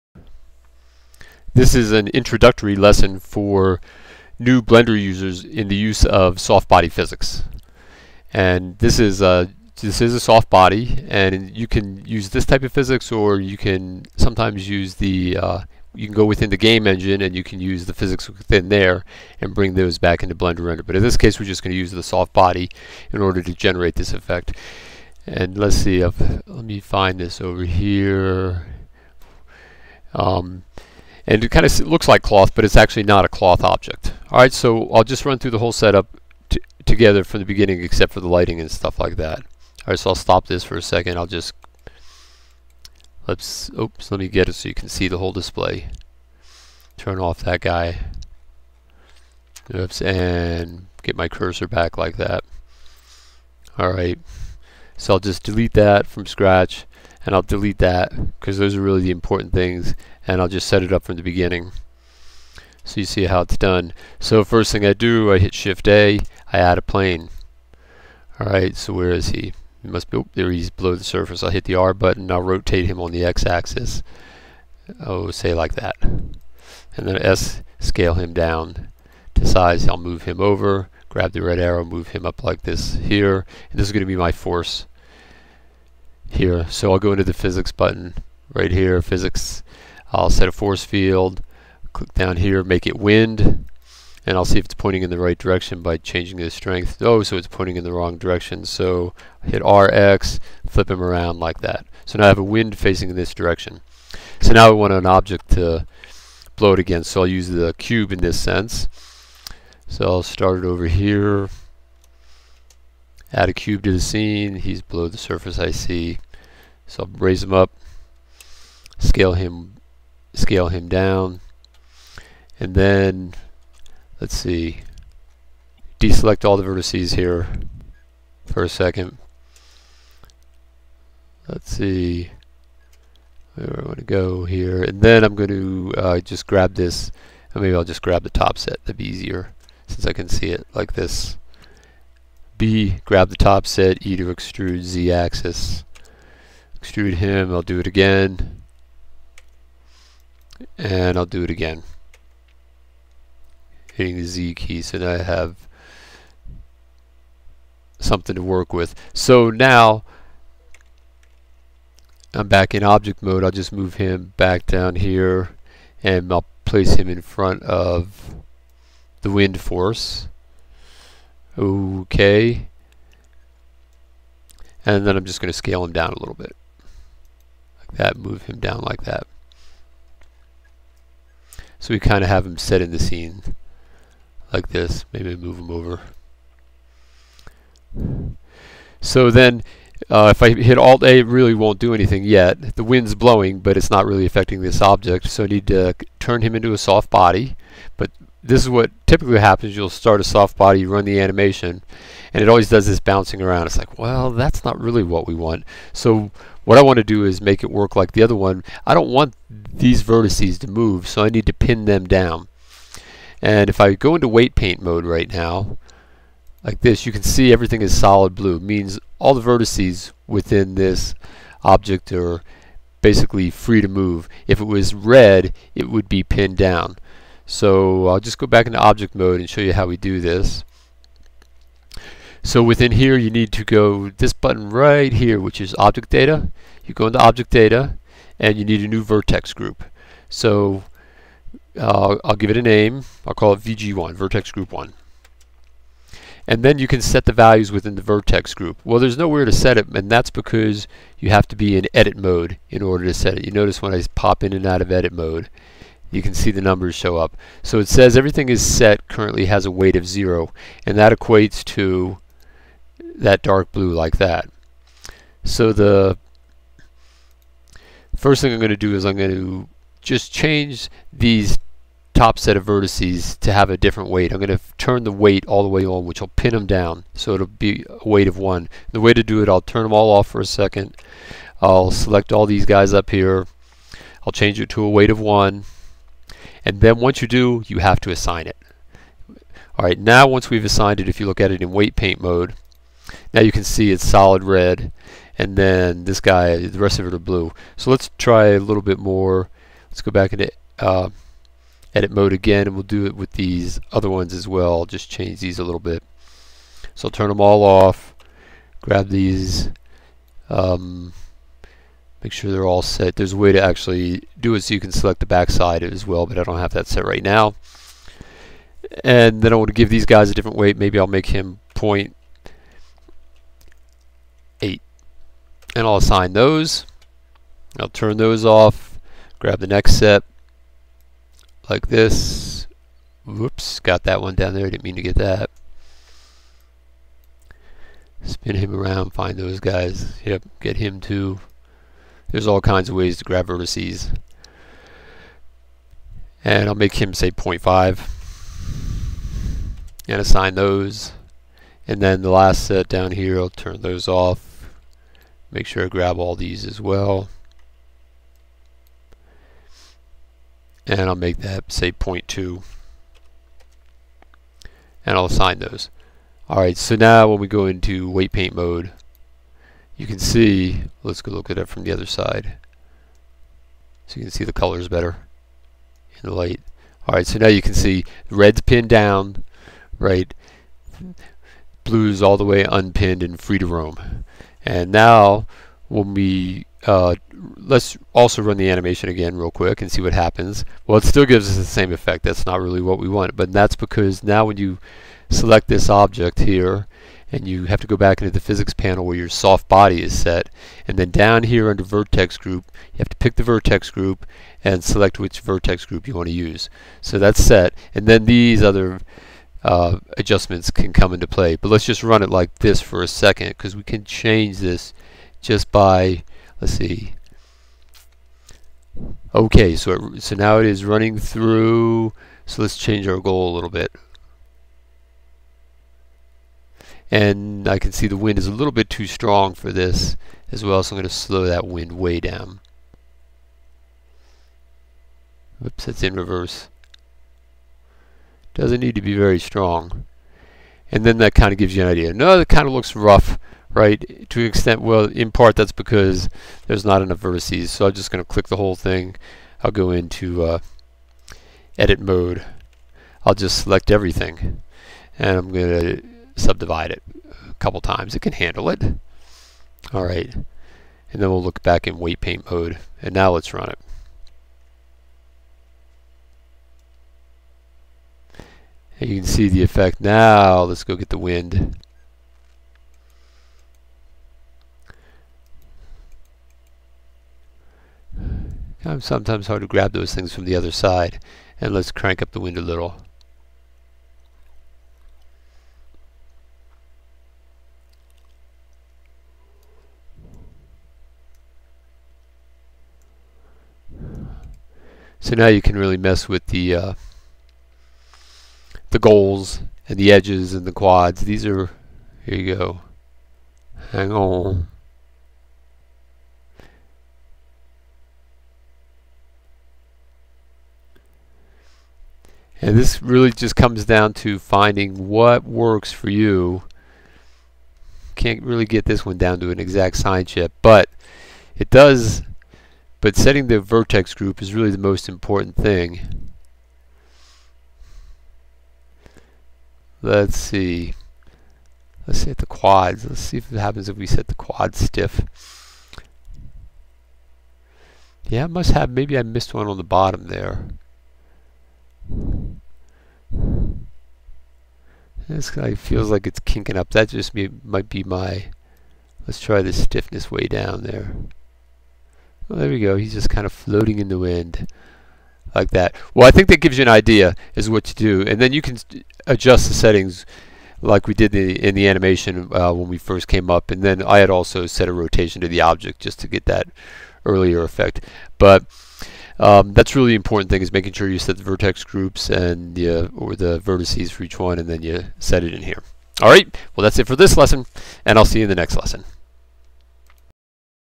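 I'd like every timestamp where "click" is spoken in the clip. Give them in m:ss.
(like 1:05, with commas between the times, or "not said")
1:31, 7:28.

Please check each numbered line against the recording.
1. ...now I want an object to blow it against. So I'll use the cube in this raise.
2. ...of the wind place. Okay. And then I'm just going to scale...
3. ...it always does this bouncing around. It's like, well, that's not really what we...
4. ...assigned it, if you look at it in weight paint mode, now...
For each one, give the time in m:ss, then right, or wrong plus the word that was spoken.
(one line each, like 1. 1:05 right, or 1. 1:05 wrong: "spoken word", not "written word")
1. 1:44 wrong: "sense", not "raise"
2. 2:47 wrong: "force", not "place"
3. 3:22 right
4. 4:50 right.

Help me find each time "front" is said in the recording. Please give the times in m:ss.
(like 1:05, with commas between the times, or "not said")
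2:47.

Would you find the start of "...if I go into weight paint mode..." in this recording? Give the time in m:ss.
3:33.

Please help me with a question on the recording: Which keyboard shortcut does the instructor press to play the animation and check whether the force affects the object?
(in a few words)
Alt A.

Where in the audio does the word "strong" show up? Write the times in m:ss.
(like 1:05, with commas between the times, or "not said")
7:09, 7:19.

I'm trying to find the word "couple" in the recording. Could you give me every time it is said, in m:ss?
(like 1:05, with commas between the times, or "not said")
7:37.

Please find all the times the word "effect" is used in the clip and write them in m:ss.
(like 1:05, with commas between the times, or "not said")
0:24, 6:31, 7:49, 9:27.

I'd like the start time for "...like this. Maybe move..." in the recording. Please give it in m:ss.
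3:04.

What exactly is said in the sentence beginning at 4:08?
Well, there's nowhere to set it, and that's because you have to be in edit mode in order to set it.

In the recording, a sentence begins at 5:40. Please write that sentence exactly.
Yep, get him to there's all kinds of ways to grab vertices.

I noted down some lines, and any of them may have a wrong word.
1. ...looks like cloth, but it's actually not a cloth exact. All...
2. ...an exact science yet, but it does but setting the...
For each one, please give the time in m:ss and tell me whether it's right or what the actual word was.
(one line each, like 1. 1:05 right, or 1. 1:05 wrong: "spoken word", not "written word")
1. 0:31 wrong: "object", not "exact"
2. 8:39 right.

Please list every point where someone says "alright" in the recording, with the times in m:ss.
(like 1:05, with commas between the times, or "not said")
1:08, 6:06, 6:17.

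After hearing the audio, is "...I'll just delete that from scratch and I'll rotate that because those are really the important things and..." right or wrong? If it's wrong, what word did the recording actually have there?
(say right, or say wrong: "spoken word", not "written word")
wrong: "delete", not "rotate".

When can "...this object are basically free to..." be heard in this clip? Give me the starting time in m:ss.
3:40.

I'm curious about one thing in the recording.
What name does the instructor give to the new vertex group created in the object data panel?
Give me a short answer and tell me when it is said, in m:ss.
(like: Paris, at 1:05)
VG1, at 4:03.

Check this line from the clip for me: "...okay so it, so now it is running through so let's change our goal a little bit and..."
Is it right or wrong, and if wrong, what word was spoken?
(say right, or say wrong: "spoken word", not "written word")
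right.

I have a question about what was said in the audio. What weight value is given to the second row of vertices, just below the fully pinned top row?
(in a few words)
0.8.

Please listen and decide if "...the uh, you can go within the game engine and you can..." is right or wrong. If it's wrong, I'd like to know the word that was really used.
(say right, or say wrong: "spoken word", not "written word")
right.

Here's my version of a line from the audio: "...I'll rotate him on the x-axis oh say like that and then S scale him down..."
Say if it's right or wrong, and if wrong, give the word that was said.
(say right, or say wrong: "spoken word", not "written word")
right.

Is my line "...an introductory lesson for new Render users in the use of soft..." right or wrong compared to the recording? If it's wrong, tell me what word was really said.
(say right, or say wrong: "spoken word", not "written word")
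wrong: "Blender", not "Render".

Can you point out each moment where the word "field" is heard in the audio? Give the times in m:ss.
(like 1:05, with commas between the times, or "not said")
1:30.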